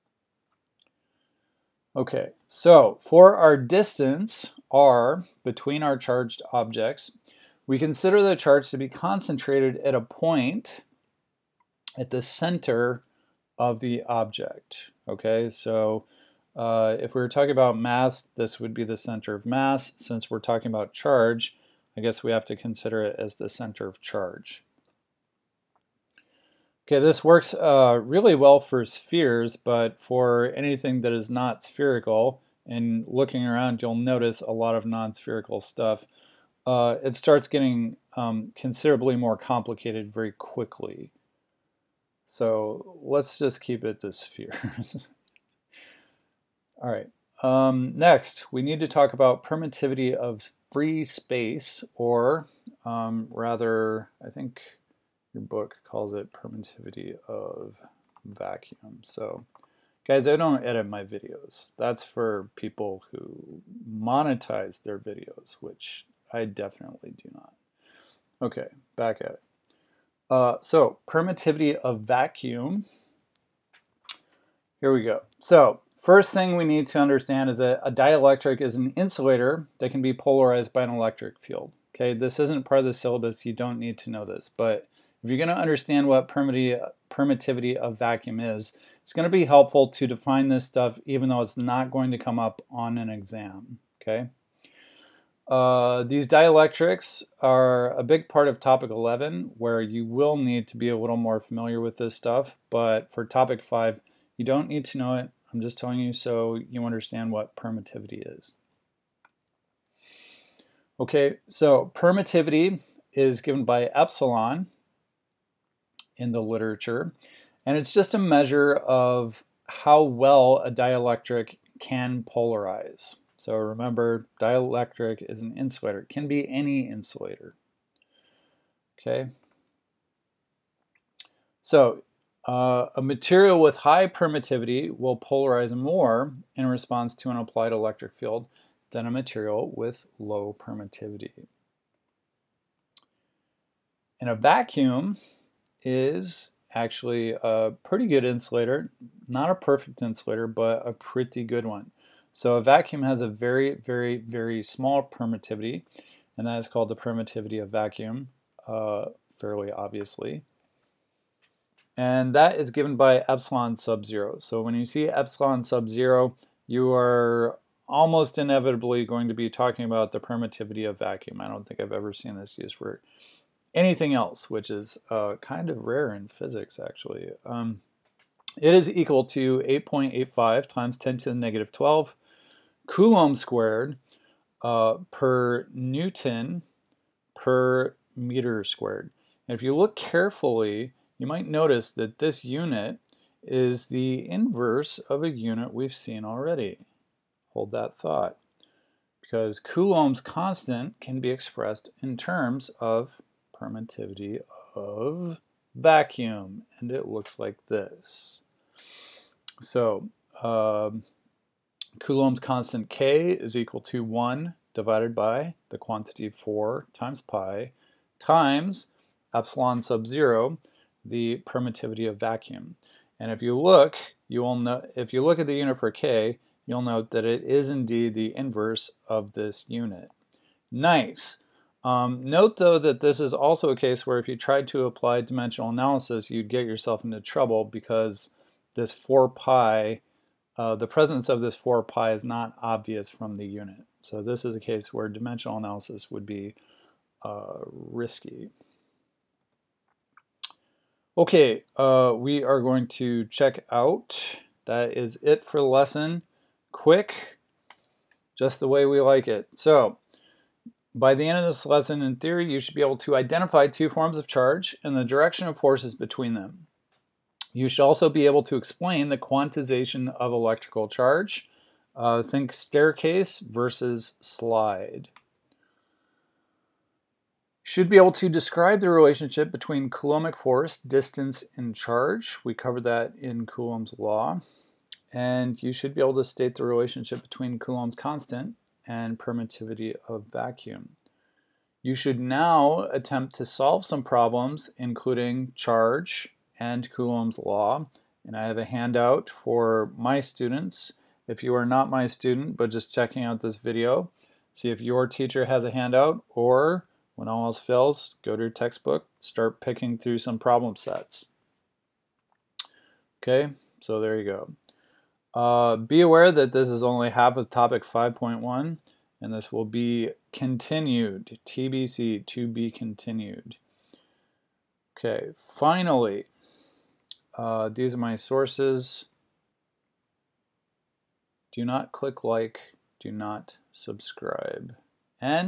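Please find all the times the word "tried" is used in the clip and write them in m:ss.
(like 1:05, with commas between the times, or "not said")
3:54.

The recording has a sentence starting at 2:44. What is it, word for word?
So when you see epsilon sub zero, you are almost inevitably going to be talking about the permittivity of vacuum.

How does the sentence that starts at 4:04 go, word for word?
So this is a case where dimensional analysis would be uh, risky.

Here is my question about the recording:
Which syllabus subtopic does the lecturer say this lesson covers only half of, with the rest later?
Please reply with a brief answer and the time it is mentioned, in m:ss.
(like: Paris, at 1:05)
5.1, at 5:17.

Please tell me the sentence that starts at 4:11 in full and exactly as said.
Okay, uh, we are going to check out.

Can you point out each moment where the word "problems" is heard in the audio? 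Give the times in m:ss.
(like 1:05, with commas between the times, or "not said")
4:54, 5:10.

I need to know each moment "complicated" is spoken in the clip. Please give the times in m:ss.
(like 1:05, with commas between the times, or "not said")
0:39.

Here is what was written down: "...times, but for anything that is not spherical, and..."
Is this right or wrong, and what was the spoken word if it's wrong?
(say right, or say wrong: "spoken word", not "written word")
wrong: "spheres", not "times".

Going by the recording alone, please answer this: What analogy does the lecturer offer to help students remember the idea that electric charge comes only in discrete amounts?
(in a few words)
staircase versus slide.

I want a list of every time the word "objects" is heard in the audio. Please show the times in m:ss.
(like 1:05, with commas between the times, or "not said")
0:06, 0:14.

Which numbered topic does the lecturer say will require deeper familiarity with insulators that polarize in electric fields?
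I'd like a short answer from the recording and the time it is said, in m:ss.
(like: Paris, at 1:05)
topic 11, at 1:38.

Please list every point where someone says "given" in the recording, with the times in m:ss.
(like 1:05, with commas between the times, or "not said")
1:53, 2:42.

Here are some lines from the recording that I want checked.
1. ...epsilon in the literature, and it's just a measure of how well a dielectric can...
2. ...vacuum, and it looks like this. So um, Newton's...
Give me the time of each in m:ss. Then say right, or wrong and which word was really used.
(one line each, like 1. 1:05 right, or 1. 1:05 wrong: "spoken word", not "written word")
1. 1:53 right
2. 3:25 wrong: "Coulomb", not "Newton".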